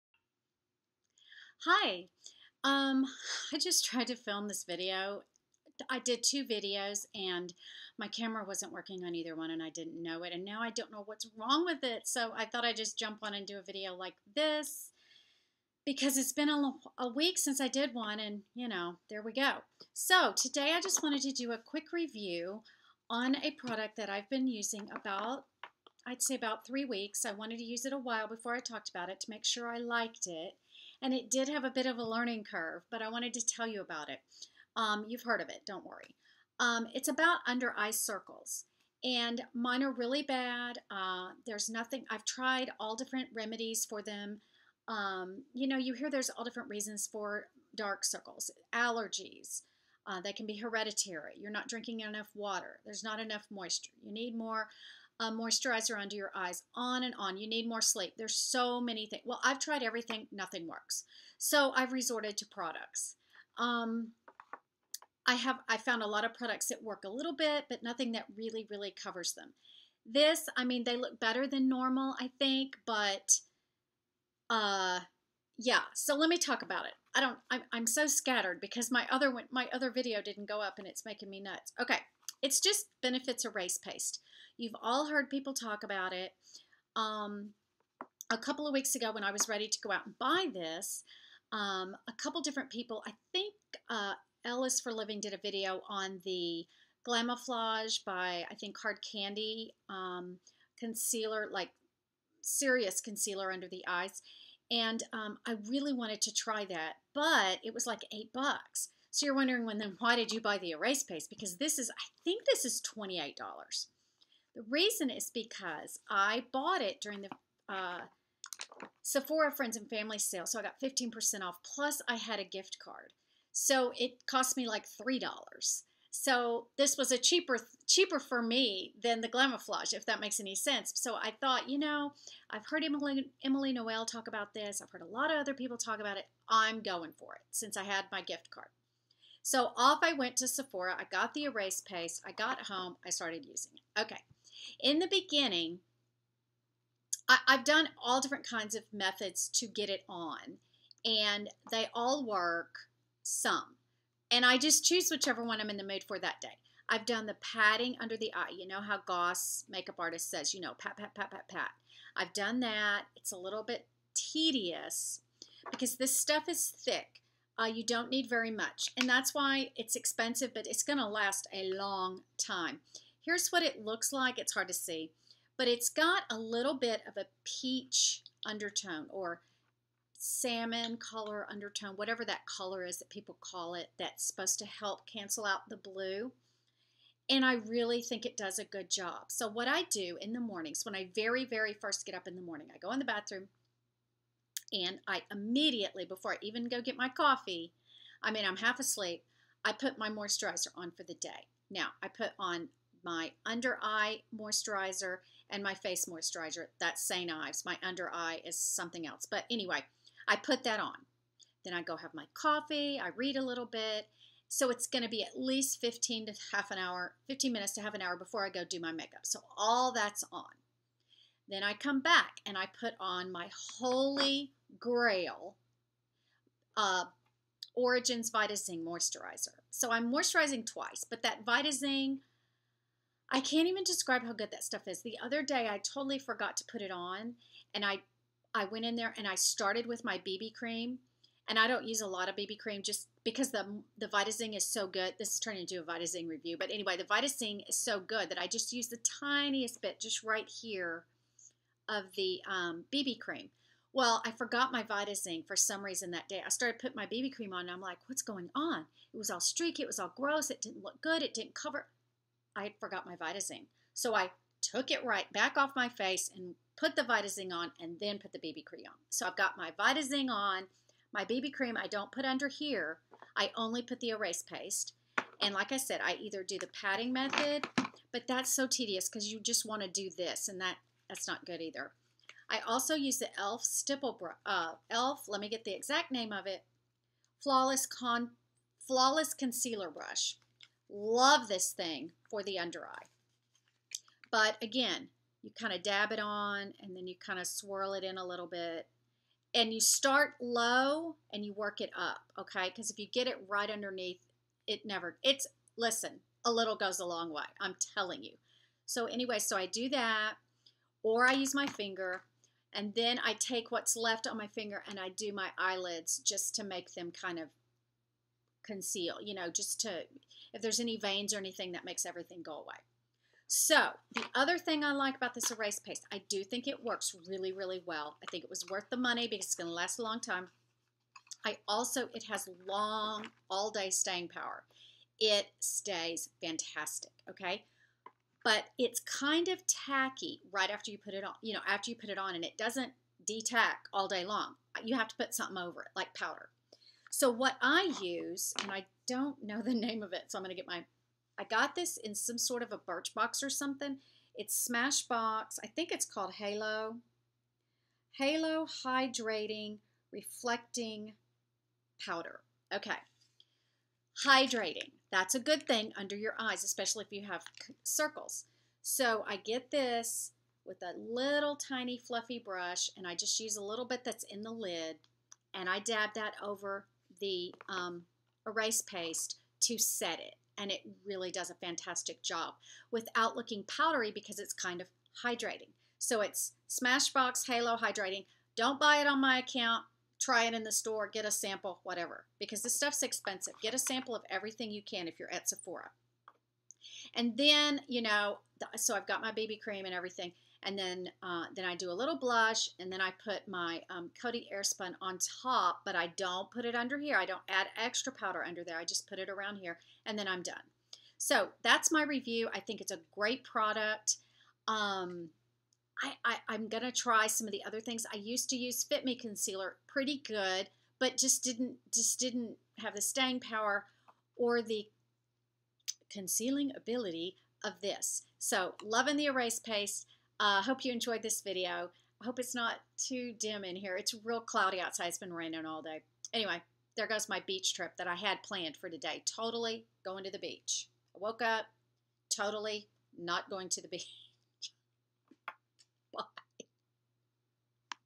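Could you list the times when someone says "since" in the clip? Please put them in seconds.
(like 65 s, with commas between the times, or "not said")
17 s, 137 s.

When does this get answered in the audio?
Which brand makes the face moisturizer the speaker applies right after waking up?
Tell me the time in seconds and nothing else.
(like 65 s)
207 s.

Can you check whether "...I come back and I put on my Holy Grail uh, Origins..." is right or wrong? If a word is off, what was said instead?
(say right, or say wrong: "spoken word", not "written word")
right.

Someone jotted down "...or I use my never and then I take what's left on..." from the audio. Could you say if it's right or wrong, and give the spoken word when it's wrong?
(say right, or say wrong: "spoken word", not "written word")
wrong: "finger", not "never".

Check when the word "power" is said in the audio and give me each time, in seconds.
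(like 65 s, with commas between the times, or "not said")
334 s, 423 s.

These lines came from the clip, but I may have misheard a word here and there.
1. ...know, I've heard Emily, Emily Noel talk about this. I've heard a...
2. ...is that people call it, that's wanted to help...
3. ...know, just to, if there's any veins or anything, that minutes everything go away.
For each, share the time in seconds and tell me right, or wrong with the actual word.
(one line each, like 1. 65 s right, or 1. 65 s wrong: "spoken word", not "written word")
1. 131 s right
2. 182 s wrong: "supposed", not "wanted"
3. 319 s wrong: "makes", not "minutes".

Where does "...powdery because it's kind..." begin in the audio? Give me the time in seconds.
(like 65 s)
383 s.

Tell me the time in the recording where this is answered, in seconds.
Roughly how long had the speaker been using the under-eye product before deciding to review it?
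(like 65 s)
26 s.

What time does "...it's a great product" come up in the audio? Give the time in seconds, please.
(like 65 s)
412 s.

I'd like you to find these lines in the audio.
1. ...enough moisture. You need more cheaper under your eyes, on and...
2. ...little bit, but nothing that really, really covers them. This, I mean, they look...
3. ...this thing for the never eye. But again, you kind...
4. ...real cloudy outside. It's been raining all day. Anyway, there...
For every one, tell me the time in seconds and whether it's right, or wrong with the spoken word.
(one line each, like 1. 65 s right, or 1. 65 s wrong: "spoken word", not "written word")
1. 53 s wrong: "moisturizer", not "cheaper"
2. 67 s right
3. 291 s wrong: "under", not "never"
4. 434 s right.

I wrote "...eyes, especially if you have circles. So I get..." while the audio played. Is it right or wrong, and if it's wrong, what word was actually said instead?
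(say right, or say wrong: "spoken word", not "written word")
right.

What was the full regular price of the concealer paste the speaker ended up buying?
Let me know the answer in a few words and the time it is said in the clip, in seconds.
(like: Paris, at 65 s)
$28, at 112 s.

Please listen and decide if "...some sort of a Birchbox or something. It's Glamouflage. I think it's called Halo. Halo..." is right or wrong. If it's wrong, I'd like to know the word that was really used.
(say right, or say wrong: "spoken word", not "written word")
wrong: "Smashbox", not "Glamouflage".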